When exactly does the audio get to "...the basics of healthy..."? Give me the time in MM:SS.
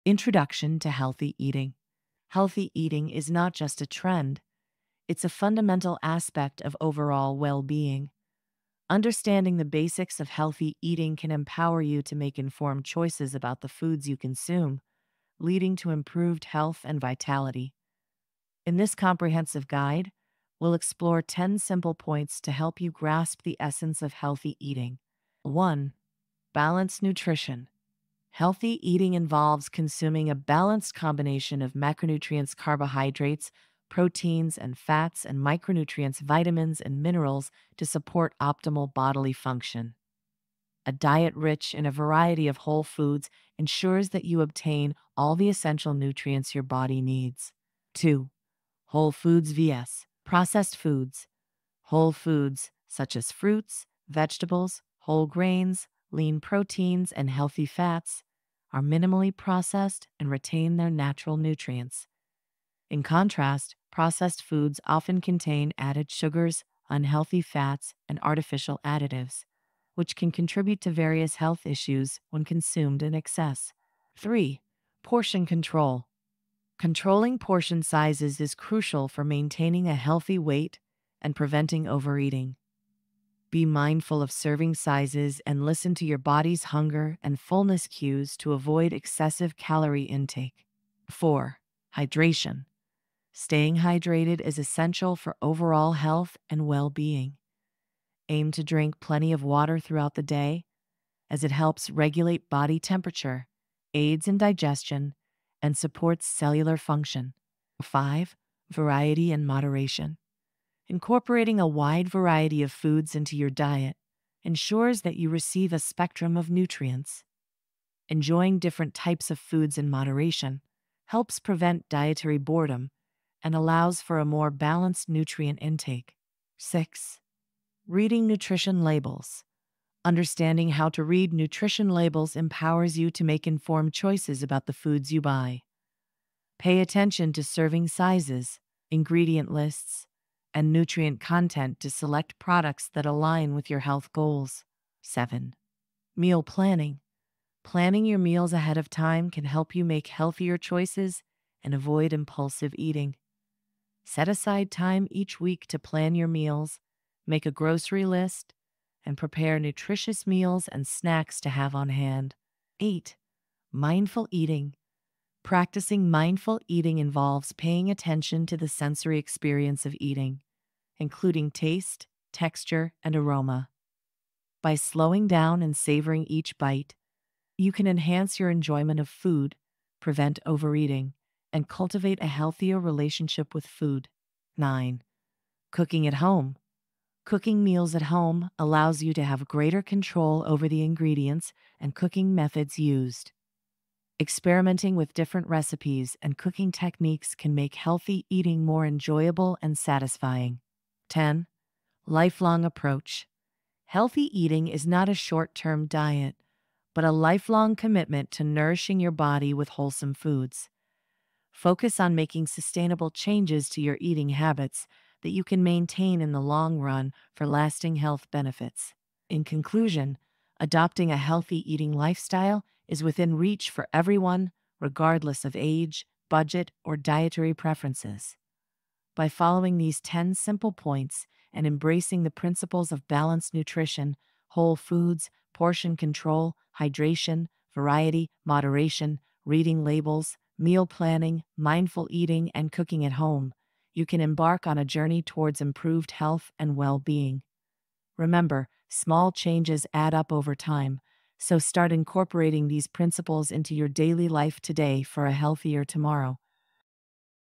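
00:09.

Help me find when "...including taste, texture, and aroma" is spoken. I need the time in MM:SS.
02:50.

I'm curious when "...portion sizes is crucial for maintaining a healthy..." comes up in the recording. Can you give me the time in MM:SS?
01:17.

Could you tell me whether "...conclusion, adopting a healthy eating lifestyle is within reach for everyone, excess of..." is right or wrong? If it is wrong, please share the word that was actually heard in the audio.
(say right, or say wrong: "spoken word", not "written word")
wrong: "regardless", not "excess".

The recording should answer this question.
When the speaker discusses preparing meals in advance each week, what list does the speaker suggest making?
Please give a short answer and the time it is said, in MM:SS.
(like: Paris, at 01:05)
grocery list, at 02:37.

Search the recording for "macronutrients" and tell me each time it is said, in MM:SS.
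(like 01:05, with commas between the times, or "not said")
00:31.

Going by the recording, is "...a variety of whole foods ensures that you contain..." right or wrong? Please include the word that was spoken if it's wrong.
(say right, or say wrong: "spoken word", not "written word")
wrong: "obtain", not "contain".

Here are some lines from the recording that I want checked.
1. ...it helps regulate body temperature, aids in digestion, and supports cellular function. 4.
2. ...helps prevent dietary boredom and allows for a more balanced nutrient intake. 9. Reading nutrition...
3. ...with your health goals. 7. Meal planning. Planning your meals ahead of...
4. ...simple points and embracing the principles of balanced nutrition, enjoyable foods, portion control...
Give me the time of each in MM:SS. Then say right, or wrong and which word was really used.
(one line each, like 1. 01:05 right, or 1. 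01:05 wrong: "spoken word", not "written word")
1. 01:41 wrong: "5", not "4"
2. 02:01 wrong: "6", not "9"
3. 02:23 right
4. 03:50 wrong: "whole", not "enjoyable".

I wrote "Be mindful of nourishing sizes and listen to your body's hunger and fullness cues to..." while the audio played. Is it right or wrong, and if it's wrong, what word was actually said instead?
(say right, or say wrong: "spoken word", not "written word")
wrong: "serving", not "nourishing".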